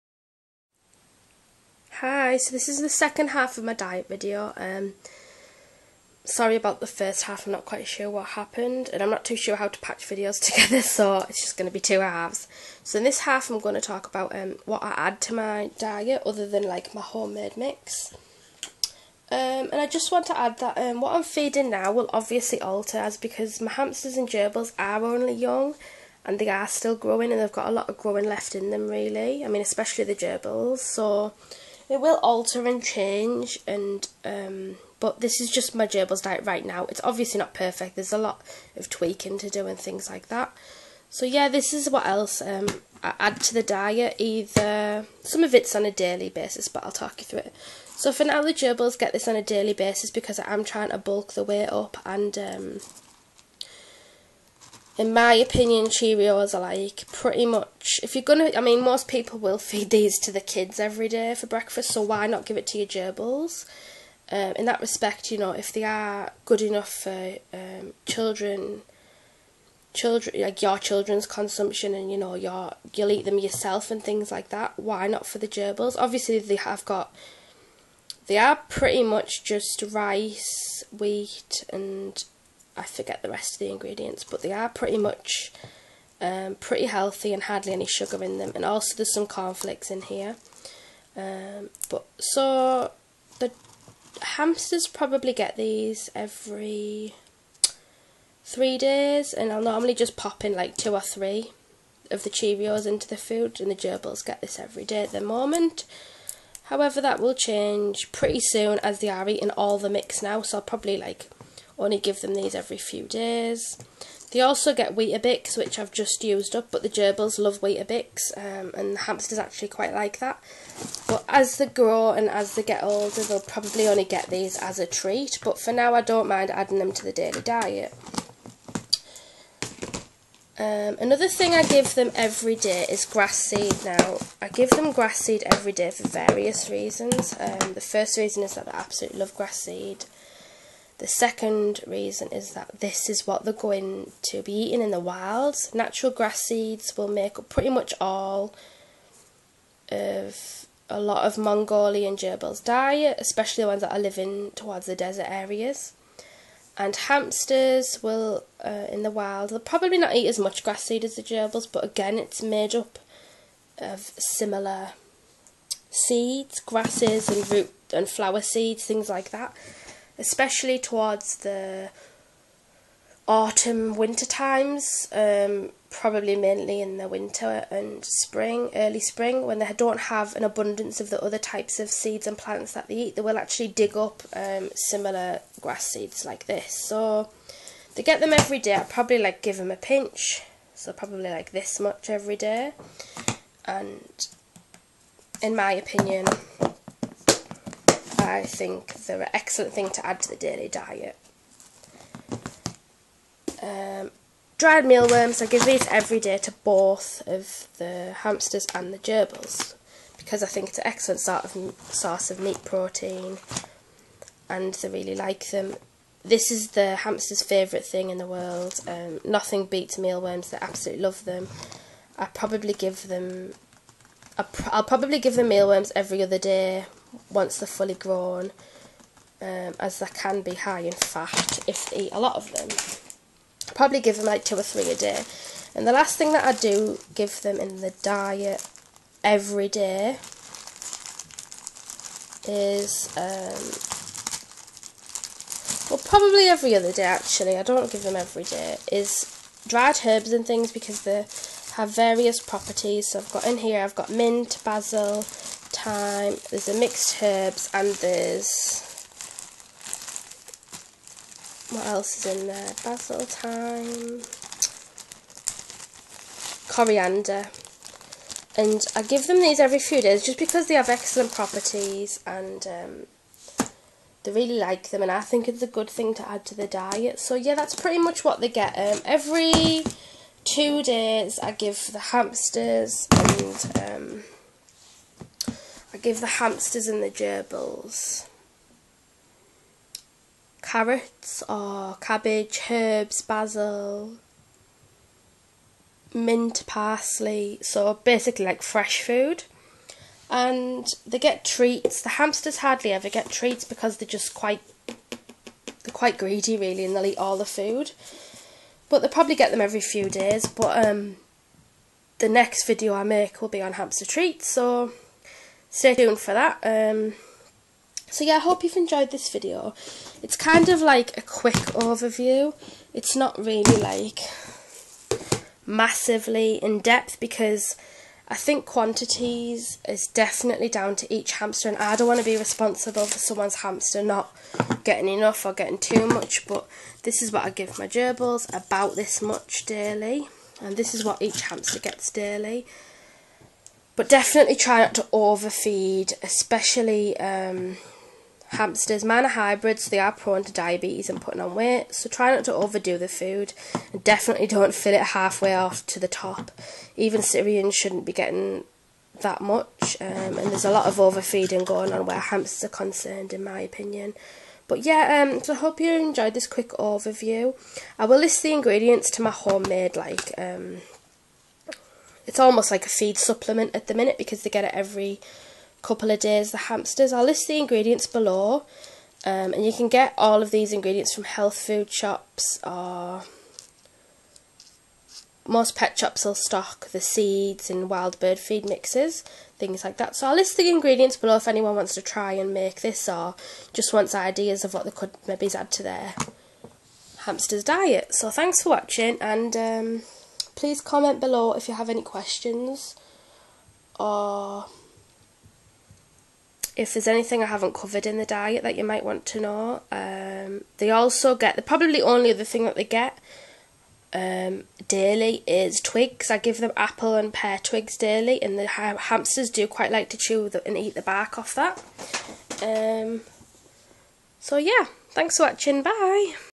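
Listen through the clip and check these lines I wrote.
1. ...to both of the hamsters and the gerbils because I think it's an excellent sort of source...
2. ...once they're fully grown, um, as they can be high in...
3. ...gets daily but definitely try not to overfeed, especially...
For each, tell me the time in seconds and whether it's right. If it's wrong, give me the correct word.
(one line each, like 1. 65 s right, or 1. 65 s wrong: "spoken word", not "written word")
1. 206 s right
2. 227 s right
3. 341 s right.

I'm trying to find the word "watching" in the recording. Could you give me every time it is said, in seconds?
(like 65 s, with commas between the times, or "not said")
398 s, 425 s.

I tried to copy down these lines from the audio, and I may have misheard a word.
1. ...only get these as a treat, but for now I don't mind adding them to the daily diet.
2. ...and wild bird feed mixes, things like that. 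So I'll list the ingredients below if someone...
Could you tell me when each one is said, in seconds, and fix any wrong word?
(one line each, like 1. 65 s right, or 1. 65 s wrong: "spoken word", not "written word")
1. 123 s right
2. 387 s wrong: "anyone", not "someone".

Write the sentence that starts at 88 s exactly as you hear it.
And also there's some cornflakes in here.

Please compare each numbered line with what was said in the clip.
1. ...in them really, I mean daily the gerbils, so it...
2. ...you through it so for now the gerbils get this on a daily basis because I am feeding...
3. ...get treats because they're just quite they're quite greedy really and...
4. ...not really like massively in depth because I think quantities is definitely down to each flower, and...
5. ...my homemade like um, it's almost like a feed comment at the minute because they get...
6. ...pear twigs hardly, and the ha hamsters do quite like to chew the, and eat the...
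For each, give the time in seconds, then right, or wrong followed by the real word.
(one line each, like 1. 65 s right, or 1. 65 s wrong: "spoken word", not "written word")
1. 28 s wrong: "especially", not "daily"
2. 47 s wrong: "trying", not "feeding"
3. 303 s right
4. 323 s wrong: "hamster", not "flower"
5. 369 s wrong: "supplement", not "comment"
6. 417 s wrong: "daily", not "hardly".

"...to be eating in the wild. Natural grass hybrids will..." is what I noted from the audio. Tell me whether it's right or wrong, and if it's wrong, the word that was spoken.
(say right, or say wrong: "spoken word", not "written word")
wrong: "seeds", not "hybrids".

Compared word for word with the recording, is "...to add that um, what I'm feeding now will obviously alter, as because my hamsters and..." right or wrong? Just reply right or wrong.
right.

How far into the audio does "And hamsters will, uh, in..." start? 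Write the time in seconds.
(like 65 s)
156 s.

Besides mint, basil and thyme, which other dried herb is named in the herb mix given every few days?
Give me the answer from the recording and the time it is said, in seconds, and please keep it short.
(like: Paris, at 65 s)
coriander, at 266 s.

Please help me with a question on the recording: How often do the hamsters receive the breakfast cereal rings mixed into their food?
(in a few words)
every 3 days.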